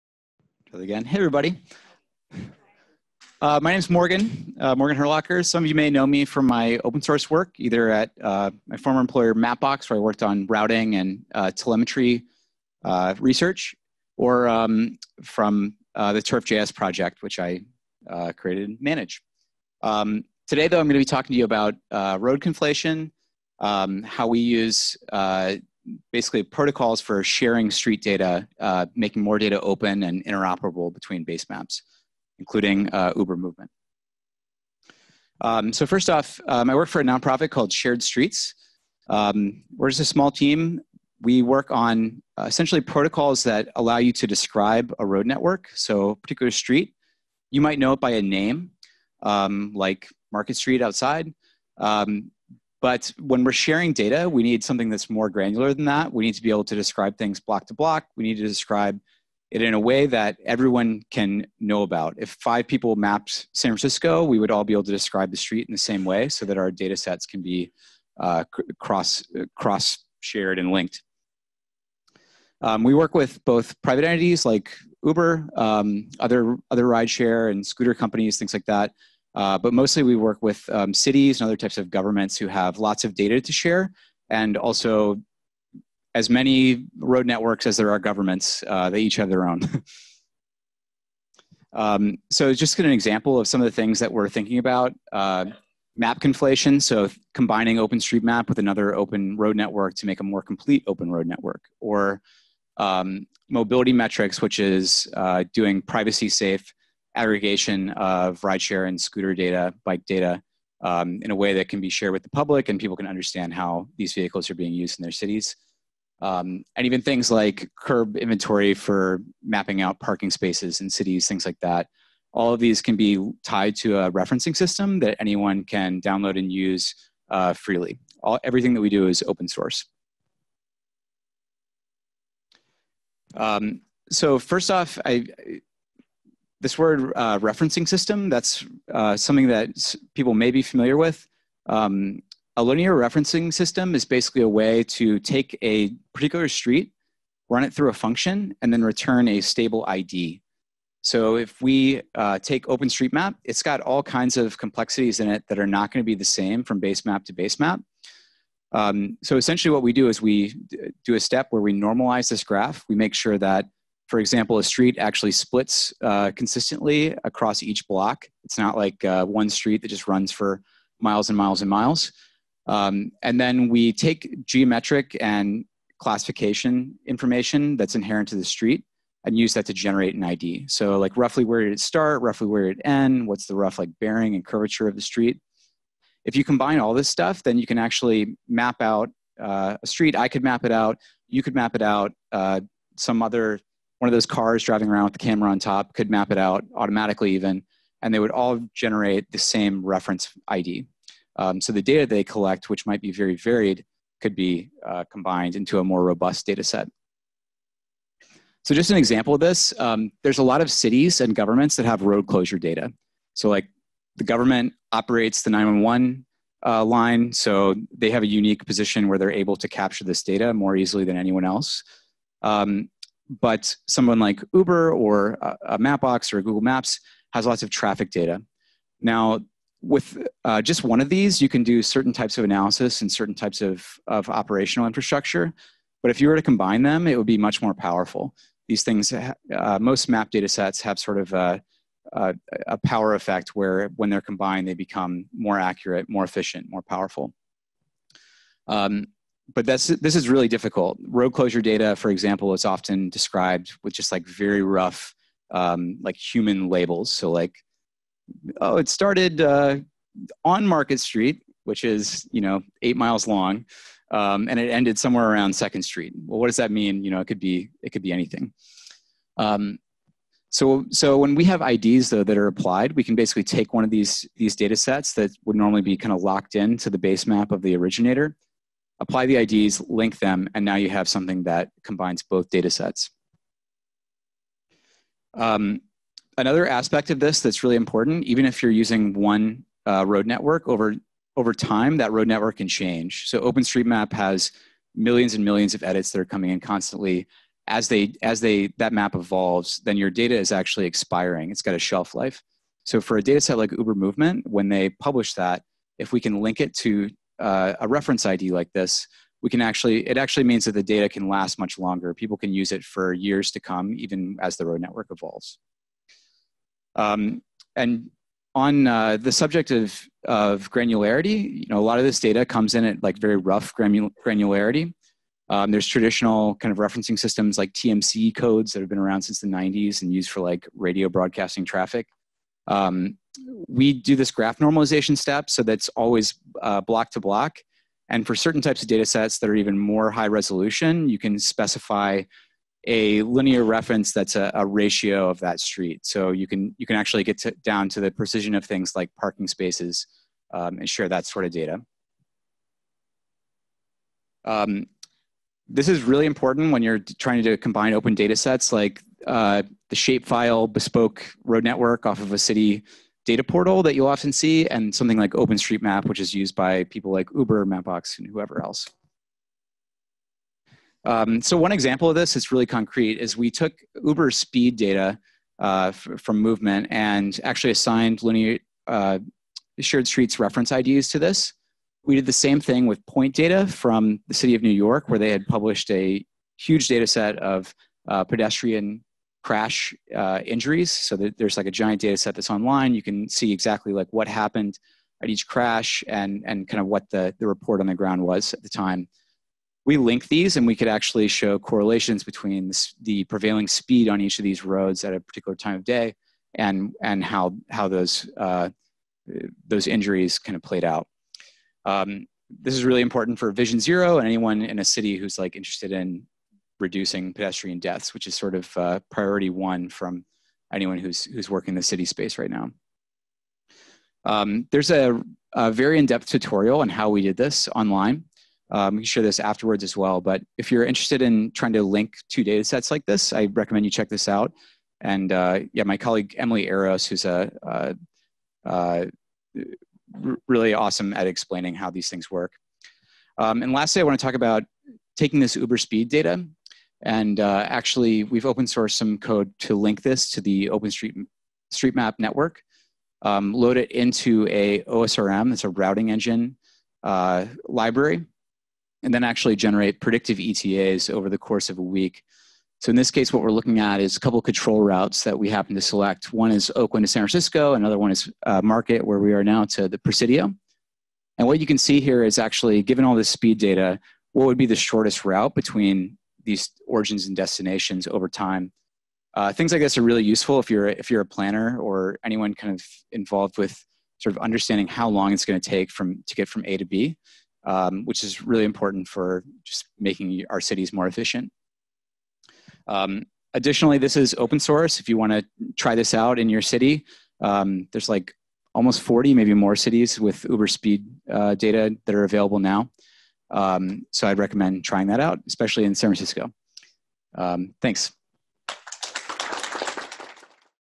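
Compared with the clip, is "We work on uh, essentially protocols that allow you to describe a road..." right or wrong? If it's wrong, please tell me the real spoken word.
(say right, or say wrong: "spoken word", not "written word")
right.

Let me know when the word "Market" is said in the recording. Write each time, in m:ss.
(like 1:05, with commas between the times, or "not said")
0:50, 4:20, 7:48.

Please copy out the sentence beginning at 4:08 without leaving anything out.
Um, but that's, this is really difficult.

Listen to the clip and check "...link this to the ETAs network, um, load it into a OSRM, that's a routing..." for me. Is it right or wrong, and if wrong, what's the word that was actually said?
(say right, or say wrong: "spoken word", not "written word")
wrong: "OpenStreetMap", not "ETAs".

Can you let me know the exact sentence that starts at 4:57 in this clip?
As they, as they, that map evolves, then your data is actually expiring.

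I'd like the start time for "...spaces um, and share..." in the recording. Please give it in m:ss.
5:49.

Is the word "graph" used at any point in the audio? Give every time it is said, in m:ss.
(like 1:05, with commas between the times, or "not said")
2:42, 5:34.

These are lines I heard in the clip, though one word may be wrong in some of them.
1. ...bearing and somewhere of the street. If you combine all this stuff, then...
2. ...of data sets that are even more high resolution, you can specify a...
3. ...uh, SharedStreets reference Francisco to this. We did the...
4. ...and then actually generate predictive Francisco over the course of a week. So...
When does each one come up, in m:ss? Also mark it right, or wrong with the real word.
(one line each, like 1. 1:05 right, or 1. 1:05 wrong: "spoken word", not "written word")
1. 3:04 wrong: "curvature", not "somewhere"
2. 5:38 right
3. 6:18 wrong: "IDs", not "Francisco"
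4. 7:39 wrong: "ETAs", not "Francisco".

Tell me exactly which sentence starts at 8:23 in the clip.
Um, so I'd recommend trying that out, especially in San Francisco.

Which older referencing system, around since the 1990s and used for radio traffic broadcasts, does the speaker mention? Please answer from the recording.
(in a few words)
TMC codes.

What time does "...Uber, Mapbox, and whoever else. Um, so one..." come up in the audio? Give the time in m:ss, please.
6:07.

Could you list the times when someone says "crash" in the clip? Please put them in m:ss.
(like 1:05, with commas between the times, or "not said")
6:29, 6:35.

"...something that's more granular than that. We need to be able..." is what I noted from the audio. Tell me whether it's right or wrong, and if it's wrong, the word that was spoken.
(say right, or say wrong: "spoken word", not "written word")
right.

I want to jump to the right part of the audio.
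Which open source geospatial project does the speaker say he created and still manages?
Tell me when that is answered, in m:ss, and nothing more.
0:16.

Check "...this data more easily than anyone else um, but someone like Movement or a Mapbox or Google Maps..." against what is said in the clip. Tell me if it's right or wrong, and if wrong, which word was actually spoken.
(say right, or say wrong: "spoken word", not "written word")
wrong: "Uber", not "Movement".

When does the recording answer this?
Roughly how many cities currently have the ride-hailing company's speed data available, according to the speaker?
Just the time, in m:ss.
8:18.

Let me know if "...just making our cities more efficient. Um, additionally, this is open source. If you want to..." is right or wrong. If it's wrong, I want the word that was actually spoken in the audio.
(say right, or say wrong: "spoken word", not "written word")
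right.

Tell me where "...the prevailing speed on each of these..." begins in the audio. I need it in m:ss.
6:43.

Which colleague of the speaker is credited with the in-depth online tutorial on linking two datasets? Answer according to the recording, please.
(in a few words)
Emily Eros.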